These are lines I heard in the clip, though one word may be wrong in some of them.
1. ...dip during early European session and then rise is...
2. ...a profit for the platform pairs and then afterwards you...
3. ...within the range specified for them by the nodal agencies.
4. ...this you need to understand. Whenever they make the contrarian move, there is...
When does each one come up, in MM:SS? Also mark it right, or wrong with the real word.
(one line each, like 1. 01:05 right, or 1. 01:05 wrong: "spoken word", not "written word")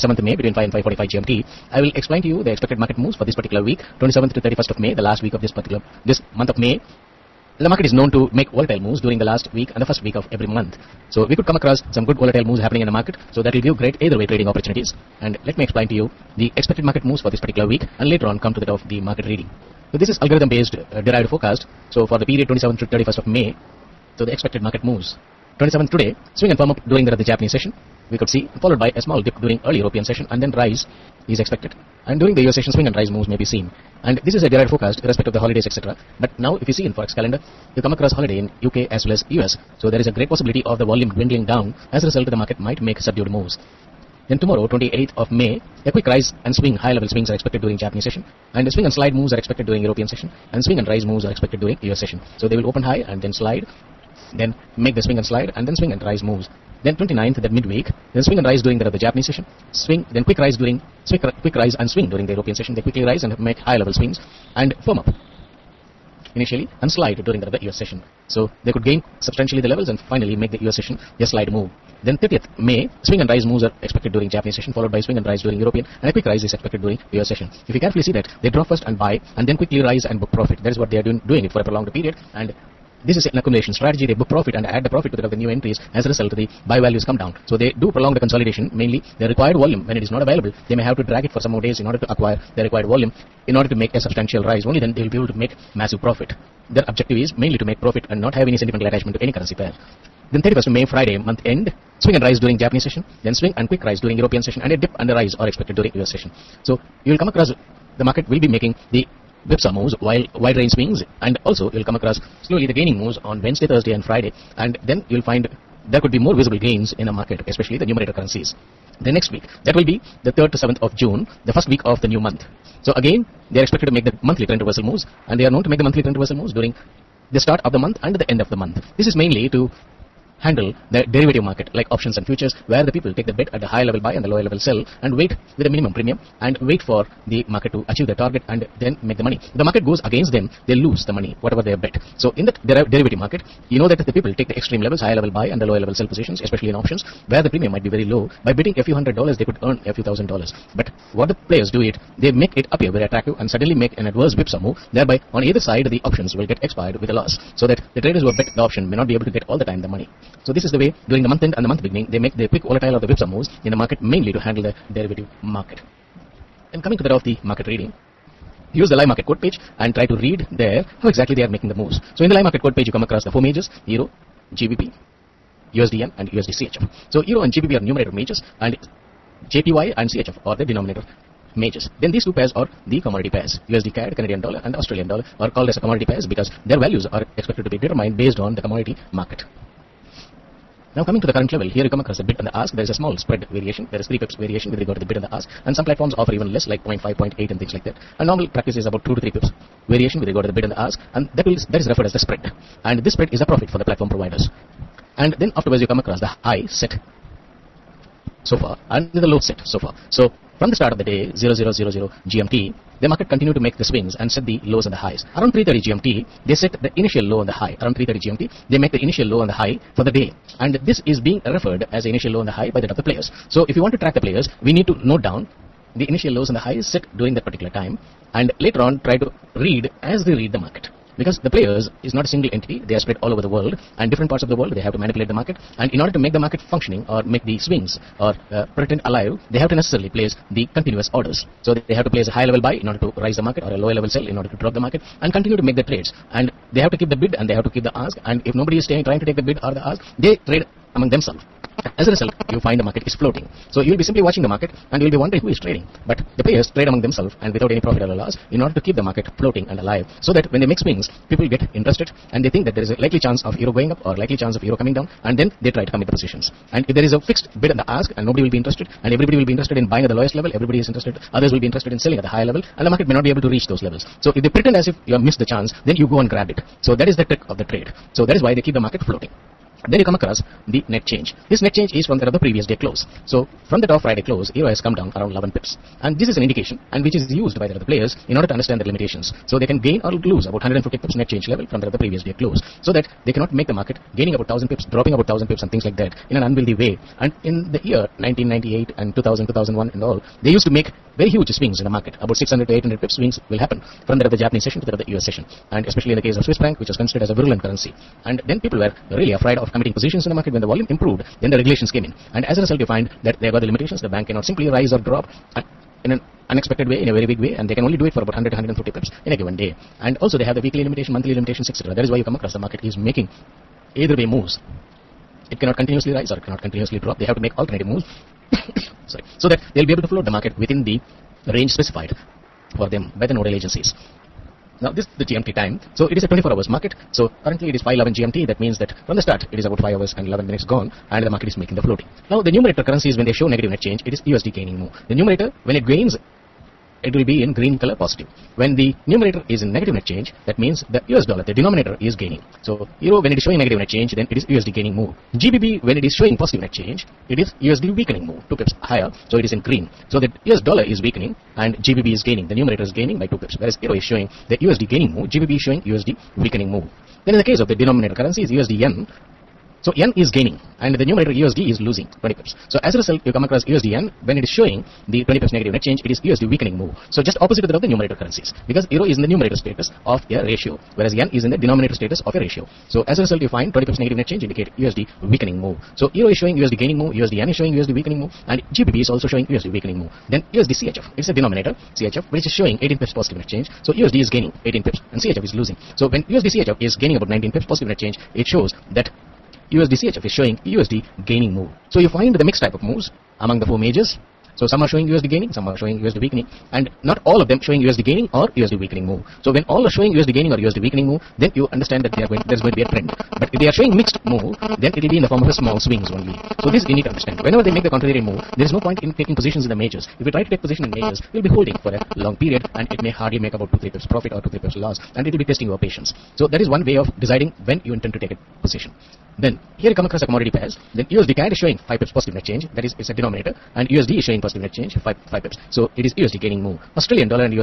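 1. 00:29 right
2. 03:23 wrong: "providers", not "pairs"
3. 05:30 right
4. 06:56 right.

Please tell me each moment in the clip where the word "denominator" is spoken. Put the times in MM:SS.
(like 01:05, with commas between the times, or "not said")
03:00, 05:51, 06:07, 06:21, 06:31, 07:13.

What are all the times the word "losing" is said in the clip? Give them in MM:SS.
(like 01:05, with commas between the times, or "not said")
06:11, 06:35.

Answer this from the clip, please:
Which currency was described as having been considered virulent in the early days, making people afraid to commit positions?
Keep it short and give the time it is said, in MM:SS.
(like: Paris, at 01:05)
Swiss franc, at 05:06.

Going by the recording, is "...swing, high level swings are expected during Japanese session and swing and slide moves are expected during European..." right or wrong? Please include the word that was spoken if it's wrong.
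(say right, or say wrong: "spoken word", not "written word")
right.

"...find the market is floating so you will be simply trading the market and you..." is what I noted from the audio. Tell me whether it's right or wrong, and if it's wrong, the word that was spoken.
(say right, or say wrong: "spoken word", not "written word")
wrong: "watching", not "trading".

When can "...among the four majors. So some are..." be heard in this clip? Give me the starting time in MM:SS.
06:43.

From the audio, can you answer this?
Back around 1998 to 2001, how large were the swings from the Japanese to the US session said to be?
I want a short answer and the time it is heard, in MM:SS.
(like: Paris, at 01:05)
600 to 800 pips, at 05:02.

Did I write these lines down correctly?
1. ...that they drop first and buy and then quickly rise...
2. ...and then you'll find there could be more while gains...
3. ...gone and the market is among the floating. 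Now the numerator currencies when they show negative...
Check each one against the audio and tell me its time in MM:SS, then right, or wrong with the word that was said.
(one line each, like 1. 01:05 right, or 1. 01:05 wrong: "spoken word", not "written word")
1. 01:18 right
2. 01:54 wrong: "visible", not "while"
3. 05:40 wrong: "making", not "among".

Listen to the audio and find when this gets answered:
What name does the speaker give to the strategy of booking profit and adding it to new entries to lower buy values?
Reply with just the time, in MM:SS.
01:23.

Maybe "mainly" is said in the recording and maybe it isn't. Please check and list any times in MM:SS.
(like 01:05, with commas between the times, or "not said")
01:28, 01:37, 02:09, 02:44.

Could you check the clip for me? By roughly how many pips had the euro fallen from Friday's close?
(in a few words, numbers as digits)
11 pips.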